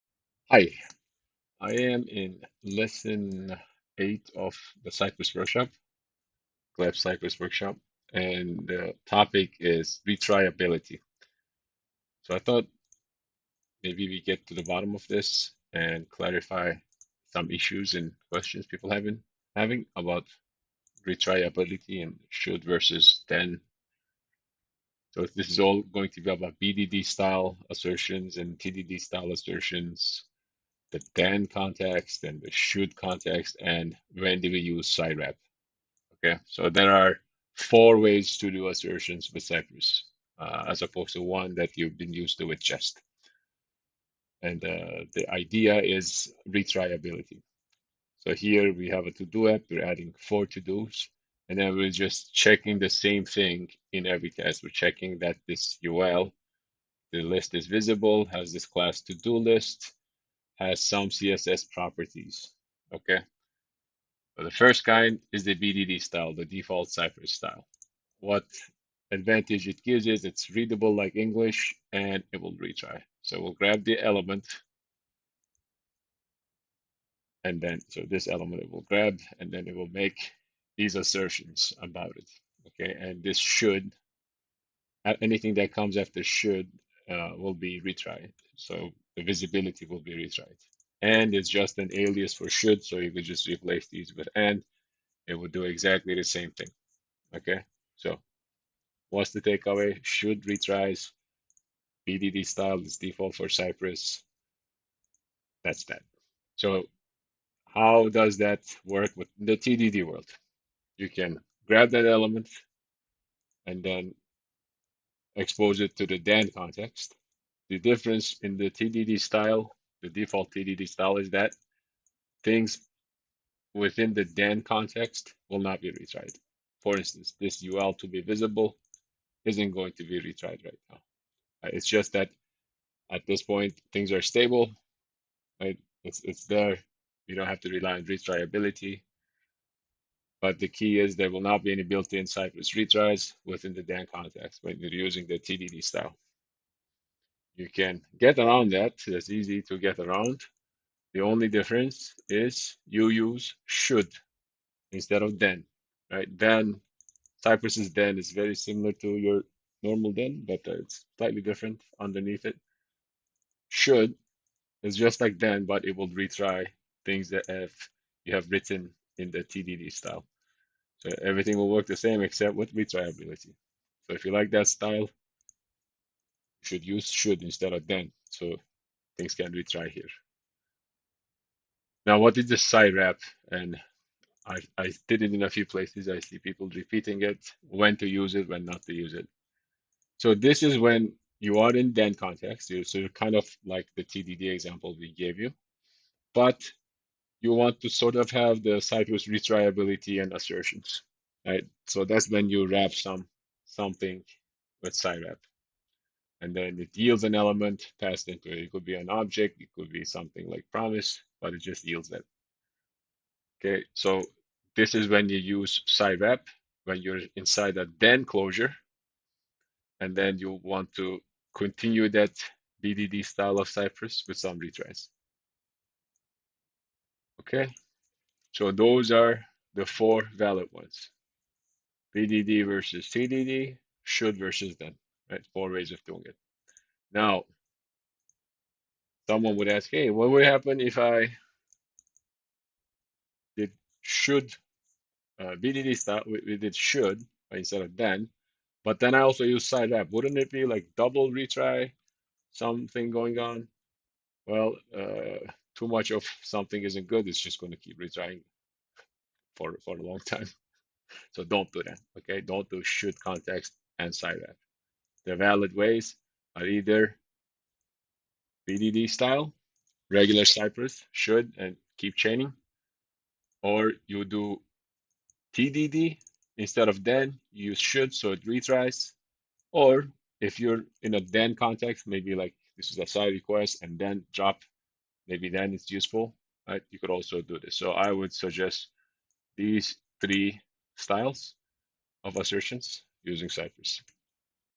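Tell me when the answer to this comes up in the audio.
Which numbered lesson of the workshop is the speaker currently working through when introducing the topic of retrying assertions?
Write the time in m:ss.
0:02.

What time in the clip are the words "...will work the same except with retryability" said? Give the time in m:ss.
2:51.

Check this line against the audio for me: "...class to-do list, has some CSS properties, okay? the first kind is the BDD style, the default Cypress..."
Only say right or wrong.
right.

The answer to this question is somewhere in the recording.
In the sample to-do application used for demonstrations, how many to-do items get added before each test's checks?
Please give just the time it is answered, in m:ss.
0:50.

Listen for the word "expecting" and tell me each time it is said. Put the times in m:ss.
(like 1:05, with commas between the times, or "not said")
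not said.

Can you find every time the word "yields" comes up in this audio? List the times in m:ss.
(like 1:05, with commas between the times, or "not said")
3:26, 3:31.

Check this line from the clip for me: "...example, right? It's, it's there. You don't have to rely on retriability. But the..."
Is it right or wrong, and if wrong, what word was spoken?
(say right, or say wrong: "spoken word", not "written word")
wrong: "stable", not "example".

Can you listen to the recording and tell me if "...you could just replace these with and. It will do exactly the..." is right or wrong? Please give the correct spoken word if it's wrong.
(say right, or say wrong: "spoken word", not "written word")
right.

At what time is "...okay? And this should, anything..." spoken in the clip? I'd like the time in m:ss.
1:22.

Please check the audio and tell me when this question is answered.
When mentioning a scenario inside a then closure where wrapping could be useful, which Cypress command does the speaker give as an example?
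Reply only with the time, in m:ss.
4:43.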